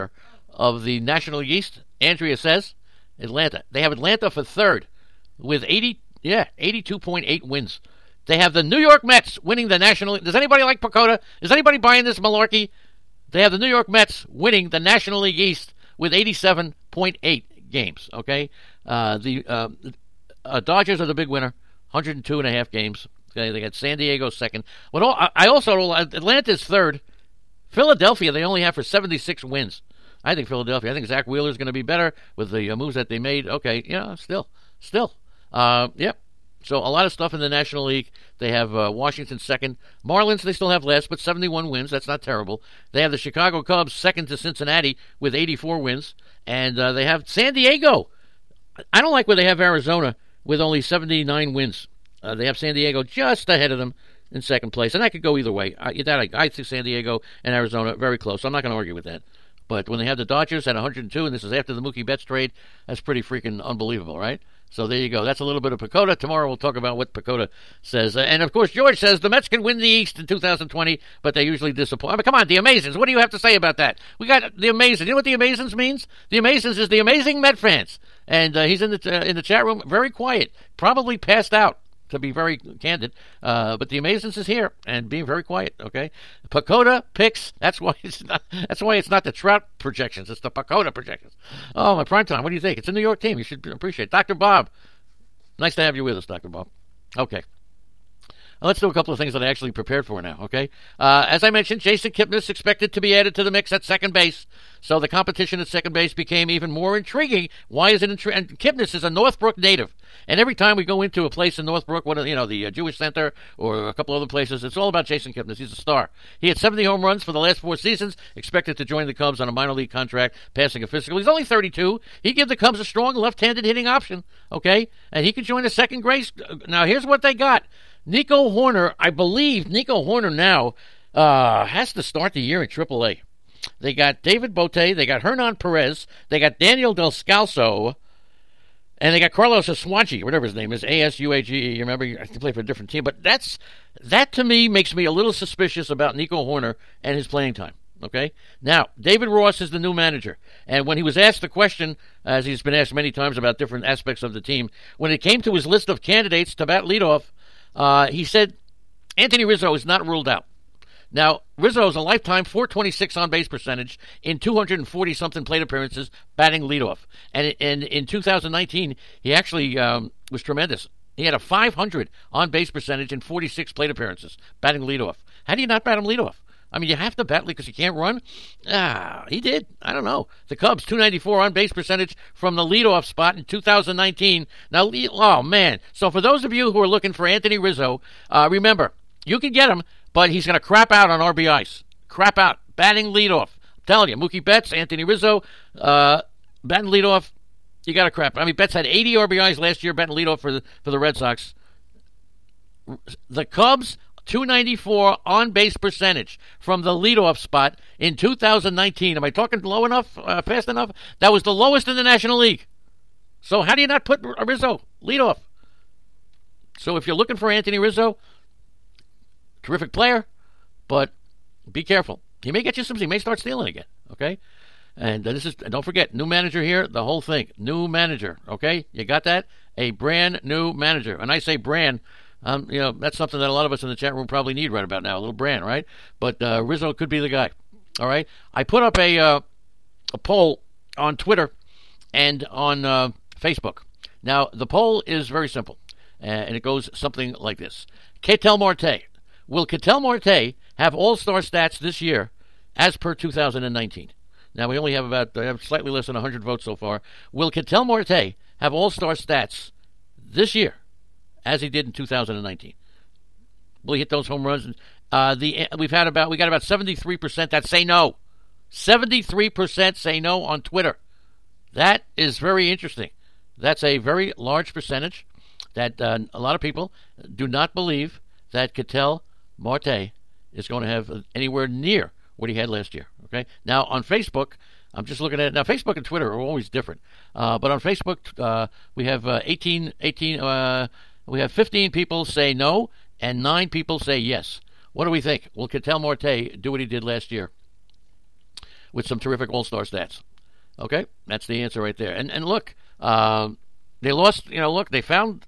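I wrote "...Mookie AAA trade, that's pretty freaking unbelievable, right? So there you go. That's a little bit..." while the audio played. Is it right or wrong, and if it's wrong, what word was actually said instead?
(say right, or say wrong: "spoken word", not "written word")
wrong: "Betts", not "AAA".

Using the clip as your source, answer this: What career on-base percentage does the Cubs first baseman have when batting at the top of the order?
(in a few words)
.426.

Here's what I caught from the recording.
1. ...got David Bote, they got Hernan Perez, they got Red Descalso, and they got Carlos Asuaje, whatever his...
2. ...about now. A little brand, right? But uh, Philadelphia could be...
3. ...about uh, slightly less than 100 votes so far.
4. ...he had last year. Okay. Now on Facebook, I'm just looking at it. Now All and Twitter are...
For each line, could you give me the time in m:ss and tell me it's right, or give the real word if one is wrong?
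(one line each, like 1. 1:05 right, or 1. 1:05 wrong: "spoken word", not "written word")
1. 2:13 wrong: "Daniel", not "Red"
2. 3:54 wrong: "Rizzo", not "Philadelphia"
3. 4:15 right
4. 4:42 wrong: "Facebook", not "All".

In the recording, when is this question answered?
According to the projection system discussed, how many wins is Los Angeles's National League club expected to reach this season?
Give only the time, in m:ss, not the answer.
0:21.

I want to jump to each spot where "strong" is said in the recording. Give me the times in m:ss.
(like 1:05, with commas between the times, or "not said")
2:02.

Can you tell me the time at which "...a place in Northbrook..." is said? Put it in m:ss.
1:51.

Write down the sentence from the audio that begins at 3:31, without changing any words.
That was the lowest in the National League.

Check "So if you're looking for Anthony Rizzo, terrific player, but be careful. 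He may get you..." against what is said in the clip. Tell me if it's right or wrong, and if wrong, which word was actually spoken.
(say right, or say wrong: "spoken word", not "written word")
right.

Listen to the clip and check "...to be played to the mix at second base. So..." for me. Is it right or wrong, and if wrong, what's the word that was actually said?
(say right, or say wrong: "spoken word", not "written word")
wrong: "added", not "played".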